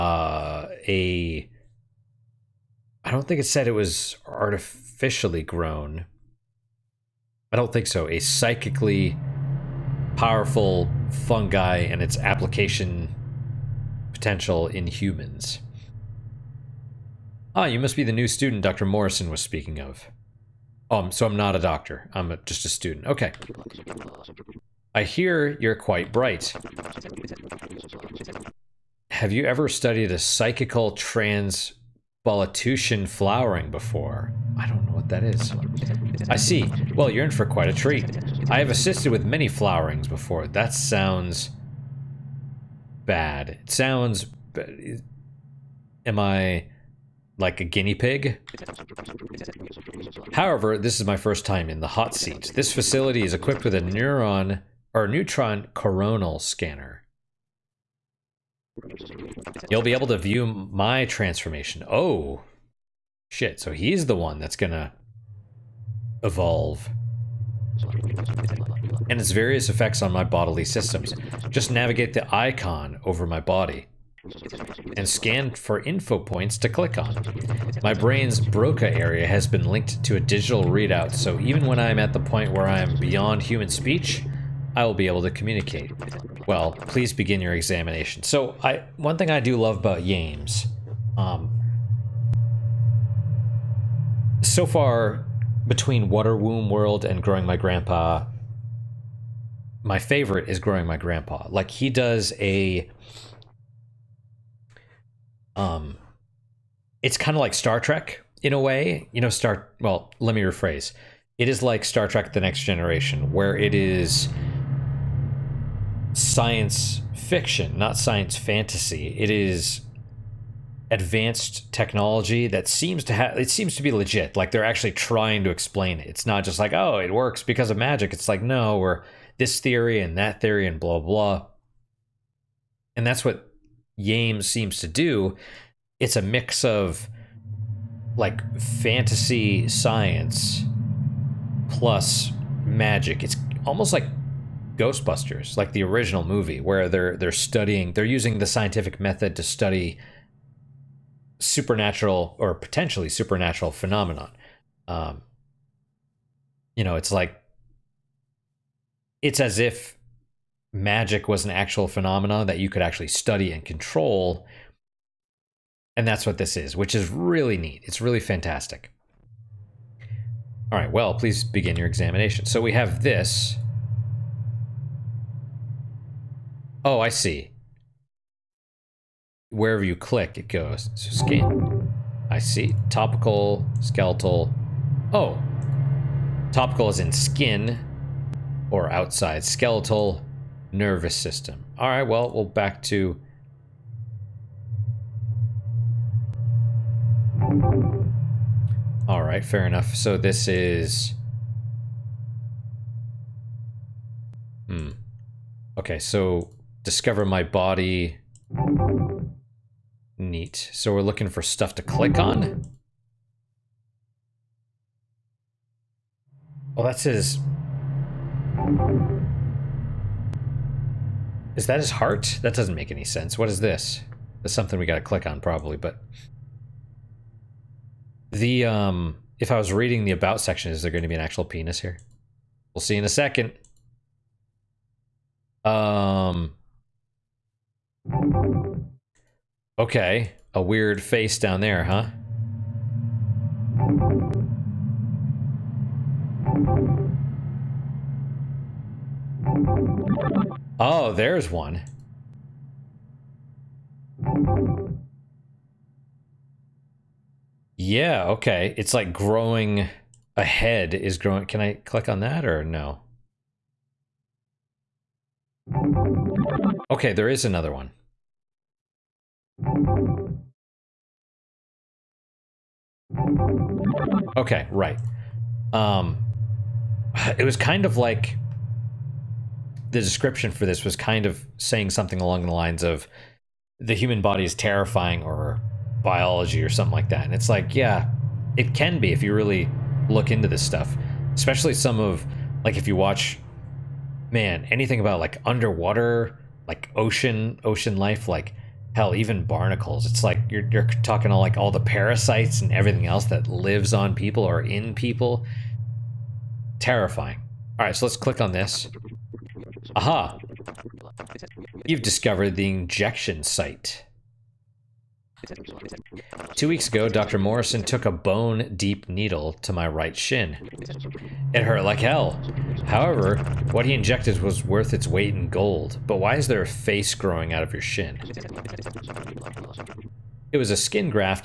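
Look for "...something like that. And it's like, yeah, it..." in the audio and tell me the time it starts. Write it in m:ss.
4:46.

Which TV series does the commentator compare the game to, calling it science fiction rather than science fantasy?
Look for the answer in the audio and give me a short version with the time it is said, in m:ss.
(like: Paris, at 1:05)
Star Trek: The Next Generation, at 1:51.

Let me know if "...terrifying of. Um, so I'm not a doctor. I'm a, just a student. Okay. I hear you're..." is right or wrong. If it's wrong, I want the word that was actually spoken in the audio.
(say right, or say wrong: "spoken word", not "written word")
wrong: "speaking", not "terrifying".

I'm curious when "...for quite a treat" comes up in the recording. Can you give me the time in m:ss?
0:37.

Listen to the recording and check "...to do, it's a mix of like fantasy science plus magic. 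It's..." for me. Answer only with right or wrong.
right.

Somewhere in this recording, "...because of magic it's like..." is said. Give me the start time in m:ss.
2:07.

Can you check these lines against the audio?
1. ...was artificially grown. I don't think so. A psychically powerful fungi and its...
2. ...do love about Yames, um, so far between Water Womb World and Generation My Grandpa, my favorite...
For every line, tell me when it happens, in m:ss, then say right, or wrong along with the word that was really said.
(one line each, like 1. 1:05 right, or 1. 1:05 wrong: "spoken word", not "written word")
1. 0:03 right
2. 1:29 wrong: "Growing", not "Generation".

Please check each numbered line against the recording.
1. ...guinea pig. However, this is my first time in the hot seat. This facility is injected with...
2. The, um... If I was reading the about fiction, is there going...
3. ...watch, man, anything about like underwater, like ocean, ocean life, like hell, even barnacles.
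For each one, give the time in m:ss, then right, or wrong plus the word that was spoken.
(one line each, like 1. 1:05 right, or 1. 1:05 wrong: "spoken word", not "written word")
1. 0:47 wrong: "equipped", not "injected"
2. 3:48 wrong: "section", not "fiction"
3. 4:52 right.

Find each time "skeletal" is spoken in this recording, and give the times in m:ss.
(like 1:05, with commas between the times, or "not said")
3:03, 3:09.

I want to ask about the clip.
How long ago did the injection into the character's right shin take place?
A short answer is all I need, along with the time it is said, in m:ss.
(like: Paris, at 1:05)
2 weeks, at 5:16.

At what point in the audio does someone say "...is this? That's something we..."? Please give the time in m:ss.
3:43.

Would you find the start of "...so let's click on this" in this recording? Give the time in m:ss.
5:07.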